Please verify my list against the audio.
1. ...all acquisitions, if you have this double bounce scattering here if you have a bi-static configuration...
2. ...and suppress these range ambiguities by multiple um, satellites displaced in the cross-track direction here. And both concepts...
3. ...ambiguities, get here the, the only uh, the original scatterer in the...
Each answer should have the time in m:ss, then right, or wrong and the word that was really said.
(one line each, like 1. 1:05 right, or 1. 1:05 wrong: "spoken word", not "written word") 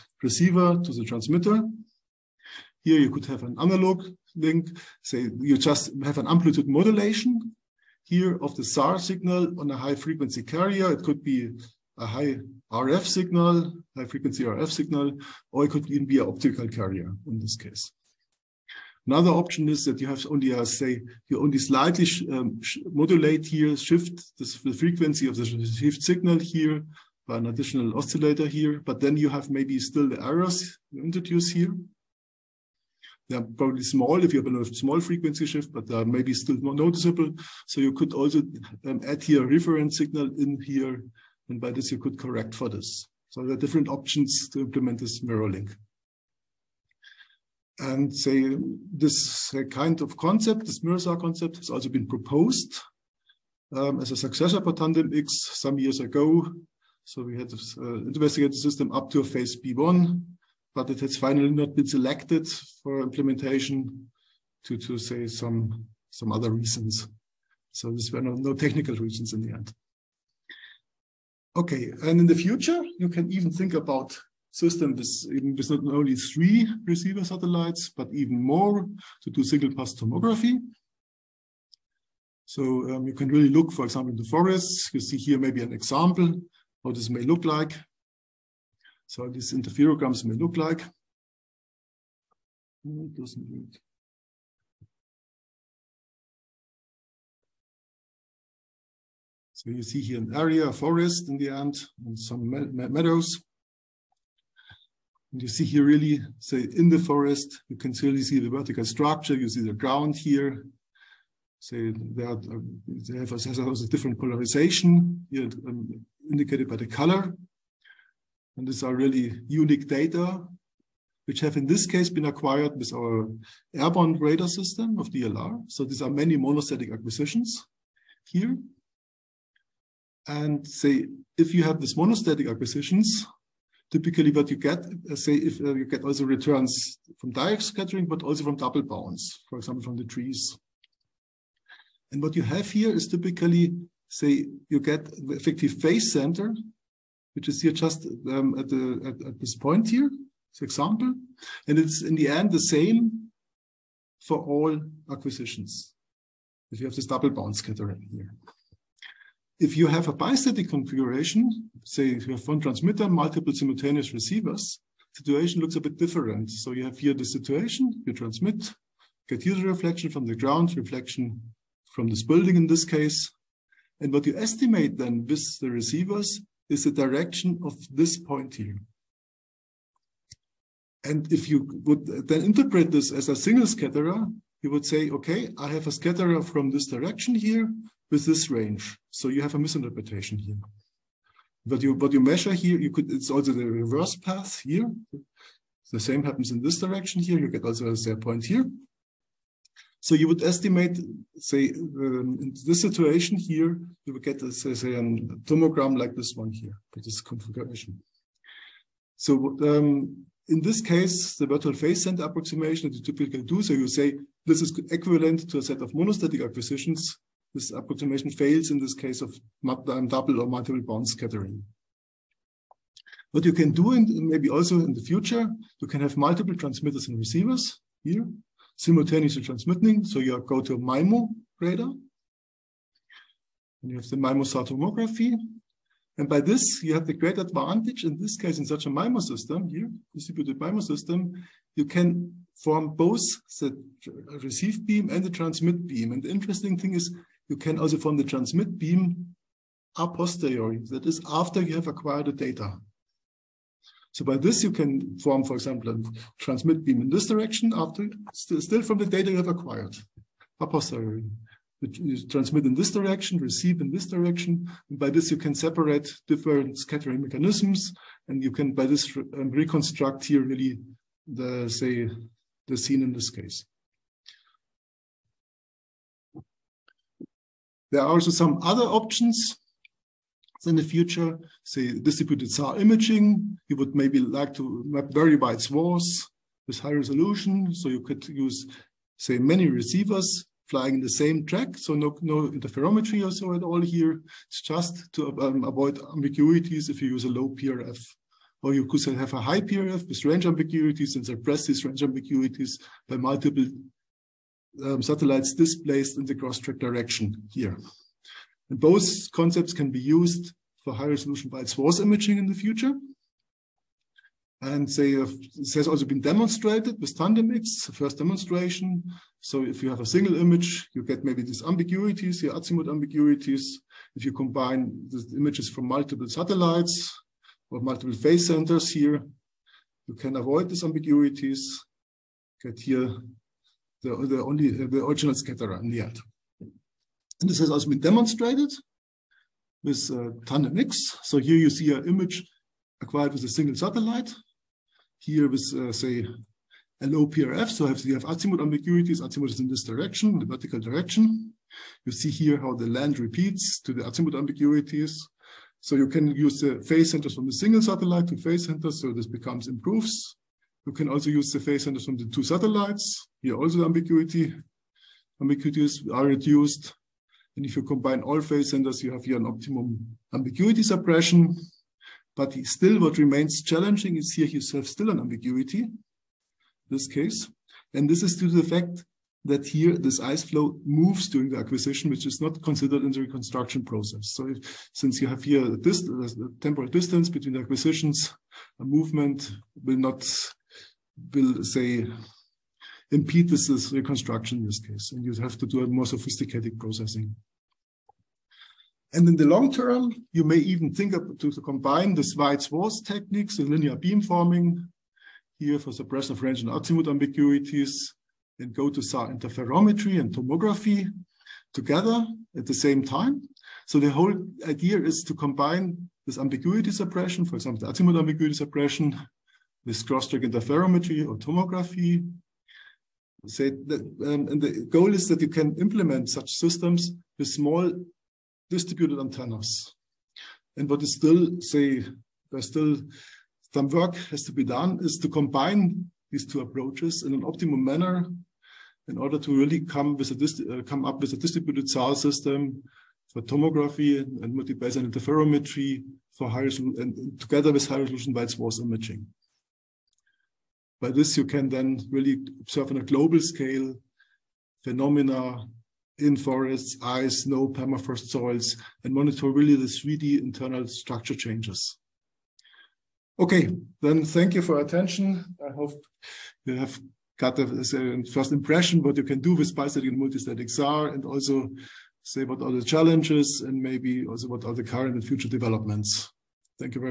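1. 2:34 right
2. 5:01 right
3. 5:30 right.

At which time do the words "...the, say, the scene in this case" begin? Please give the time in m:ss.
4:31.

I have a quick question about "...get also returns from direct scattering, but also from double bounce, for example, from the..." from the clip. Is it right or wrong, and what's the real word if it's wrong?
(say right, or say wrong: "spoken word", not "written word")
right.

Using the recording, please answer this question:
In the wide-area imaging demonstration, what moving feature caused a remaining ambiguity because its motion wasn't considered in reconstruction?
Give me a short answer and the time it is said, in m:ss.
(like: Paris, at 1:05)
ice flow, at 6:20.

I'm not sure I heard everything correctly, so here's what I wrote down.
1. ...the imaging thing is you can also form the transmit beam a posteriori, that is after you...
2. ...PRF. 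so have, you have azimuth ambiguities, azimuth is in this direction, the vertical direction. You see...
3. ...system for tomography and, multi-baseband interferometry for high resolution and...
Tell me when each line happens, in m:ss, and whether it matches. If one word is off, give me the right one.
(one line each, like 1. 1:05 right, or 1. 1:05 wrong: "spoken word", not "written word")
1. 4:06 wrong: "interesting", not "imaging"
2. 5:47 right
3. 7:22 right.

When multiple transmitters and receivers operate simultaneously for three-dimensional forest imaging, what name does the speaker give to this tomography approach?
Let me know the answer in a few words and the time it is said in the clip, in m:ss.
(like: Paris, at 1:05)
MIMO-SAR tomography, at 3:54.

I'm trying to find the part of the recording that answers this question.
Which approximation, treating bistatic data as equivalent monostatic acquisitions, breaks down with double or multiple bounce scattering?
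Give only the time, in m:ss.
3:31.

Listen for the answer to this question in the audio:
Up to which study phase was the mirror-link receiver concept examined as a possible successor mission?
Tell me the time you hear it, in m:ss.
0:59.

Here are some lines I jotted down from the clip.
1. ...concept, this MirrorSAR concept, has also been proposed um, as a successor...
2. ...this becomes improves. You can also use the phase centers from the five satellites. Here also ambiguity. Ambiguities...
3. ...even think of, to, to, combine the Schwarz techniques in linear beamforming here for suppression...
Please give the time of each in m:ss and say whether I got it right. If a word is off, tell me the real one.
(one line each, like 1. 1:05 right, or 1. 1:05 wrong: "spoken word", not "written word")
1. 0:50 right
2. 5:59 wrong: "two", not "five"
3. 6:40 right.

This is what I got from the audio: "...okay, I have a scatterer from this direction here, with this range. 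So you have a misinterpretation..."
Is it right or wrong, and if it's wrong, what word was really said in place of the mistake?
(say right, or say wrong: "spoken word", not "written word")
right.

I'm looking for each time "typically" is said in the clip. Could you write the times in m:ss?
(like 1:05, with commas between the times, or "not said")
2:13, 2:23, 3:33.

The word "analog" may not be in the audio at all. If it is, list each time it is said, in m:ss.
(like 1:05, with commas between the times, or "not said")
0:03.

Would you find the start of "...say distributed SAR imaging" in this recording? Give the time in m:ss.
4:41.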